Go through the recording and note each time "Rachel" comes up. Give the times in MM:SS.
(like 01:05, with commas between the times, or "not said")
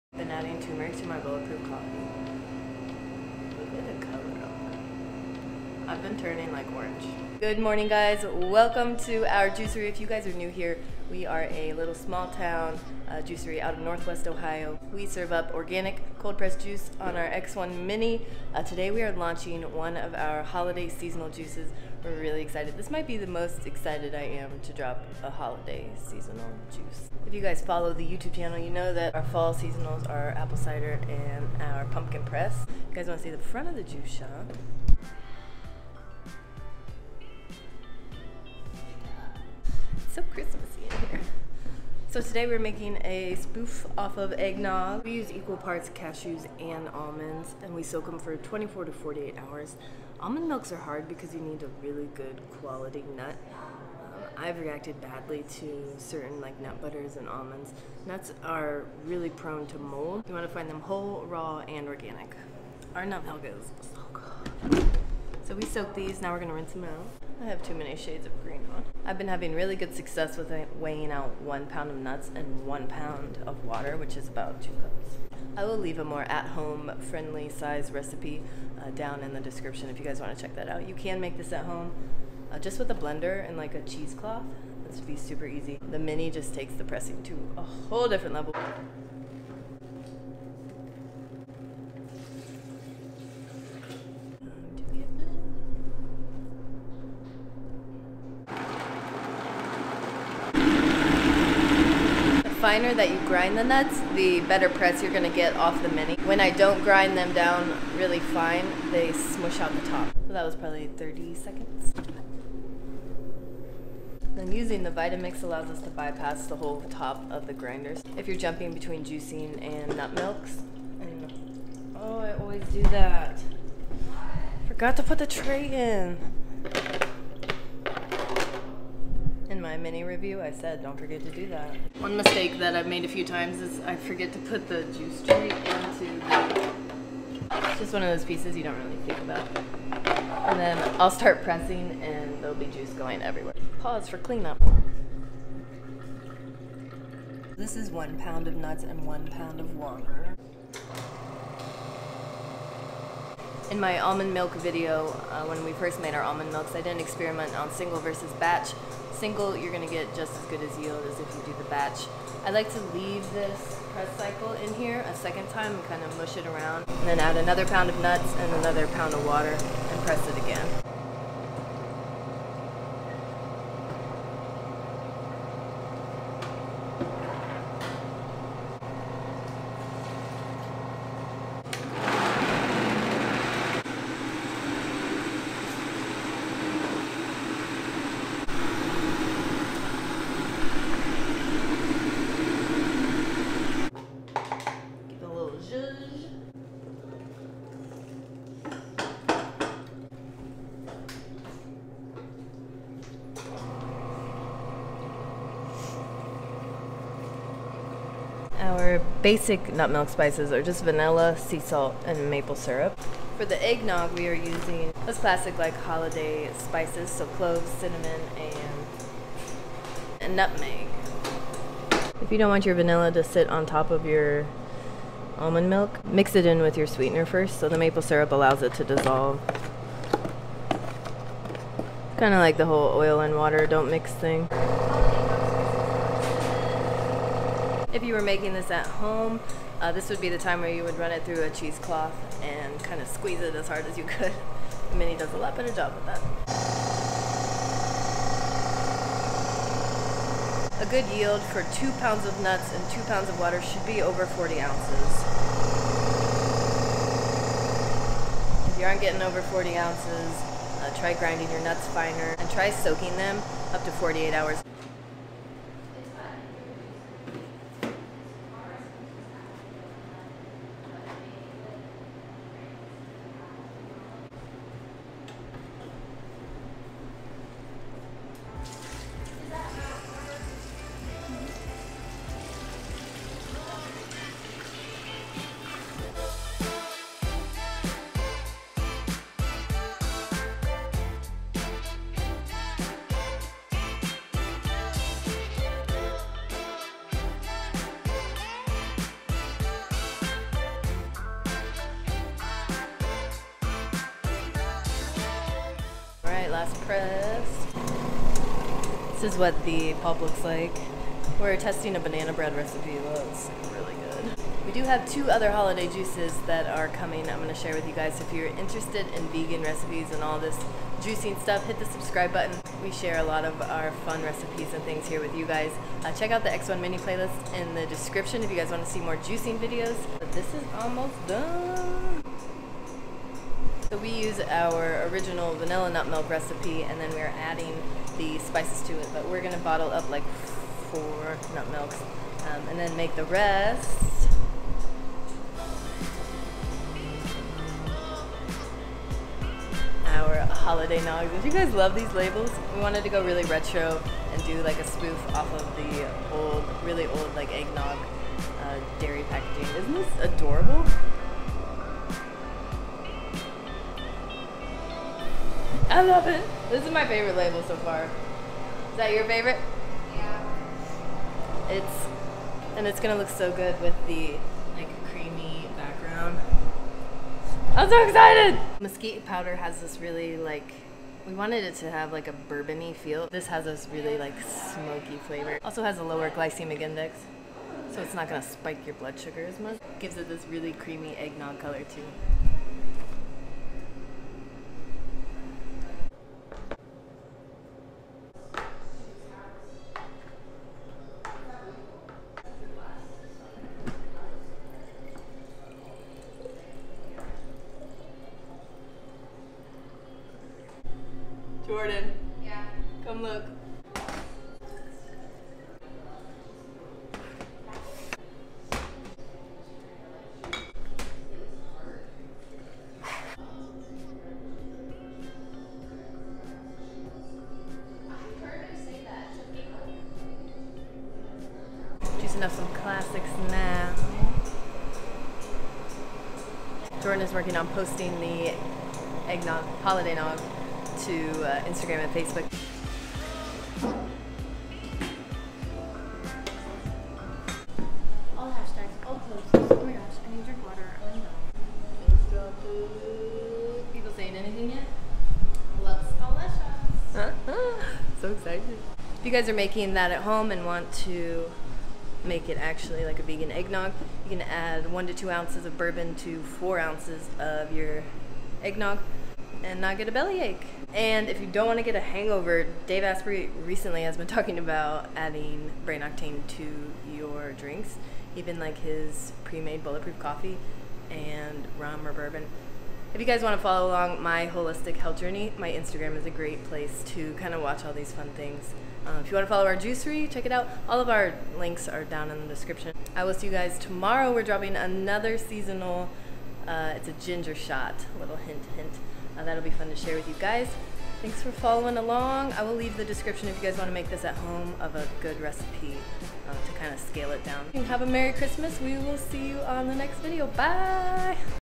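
not said.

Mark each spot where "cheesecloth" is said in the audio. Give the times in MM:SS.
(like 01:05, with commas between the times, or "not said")
01:23, 04:01.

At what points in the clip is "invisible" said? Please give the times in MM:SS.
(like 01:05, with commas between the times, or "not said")
not said.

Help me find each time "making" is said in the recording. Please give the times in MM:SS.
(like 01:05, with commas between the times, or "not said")
00:42, 03:58, 07:39.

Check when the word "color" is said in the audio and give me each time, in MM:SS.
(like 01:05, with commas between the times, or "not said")
00:04, 06:31.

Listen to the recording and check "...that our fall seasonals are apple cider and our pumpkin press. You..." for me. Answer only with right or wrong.
right.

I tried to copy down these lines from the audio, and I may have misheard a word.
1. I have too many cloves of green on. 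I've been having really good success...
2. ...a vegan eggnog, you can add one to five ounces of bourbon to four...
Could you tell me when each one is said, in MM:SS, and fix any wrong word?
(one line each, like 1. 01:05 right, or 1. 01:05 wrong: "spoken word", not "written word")
1. 01:07 wrong: "shades", not "cloves"
2. 07:43 wrong: "two", not "five".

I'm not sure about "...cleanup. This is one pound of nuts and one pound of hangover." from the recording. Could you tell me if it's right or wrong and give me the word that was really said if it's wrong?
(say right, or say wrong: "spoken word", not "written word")
wrong: "water", not "hangover".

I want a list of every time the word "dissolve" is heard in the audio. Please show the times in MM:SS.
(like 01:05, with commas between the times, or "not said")
03:48.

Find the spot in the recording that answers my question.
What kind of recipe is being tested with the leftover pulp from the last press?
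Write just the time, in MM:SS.
05:11.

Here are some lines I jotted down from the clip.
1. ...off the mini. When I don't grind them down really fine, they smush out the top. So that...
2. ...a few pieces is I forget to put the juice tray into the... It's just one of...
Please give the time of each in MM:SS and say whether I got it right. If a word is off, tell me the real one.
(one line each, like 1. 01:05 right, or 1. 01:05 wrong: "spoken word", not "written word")
1. 01:45 right
2. 02:13 wrong: "times", not "pieces".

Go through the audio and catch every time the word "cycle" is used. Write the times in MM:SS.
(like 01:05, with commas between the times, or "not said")
02:44.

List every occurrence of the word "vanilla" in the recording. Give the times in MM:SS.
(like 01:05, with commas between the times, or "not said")
03:30, 03:42, 05:35.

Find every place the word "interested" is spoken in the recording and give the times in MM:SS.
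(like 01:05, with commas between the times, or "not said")
05:18.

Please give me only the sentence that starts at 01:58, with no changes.
If you're jumping between juicing and nut milks.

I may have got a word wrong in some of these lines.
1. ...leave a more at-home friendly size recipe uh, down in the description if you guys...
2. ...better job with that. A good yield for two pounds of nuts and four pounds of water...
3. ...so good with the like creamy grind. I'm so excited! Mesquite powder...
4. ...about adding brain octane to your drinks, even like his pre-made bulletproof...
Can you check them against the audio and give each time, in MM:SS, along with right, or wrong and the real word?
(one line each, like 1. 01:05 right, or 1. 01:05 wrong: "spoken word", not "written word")
1. 01:15 right
2. 04:05 wrong: "two", not "four"
3. 06:13 wrong: "background", not "grind"
4. 07:54 right.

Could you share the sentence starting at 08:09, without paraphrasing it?
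Um, if you want to follow our juicery, check it out.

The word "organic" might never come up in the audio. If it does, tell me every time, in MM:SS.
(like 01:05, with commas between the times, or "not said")
00:15, 01:01.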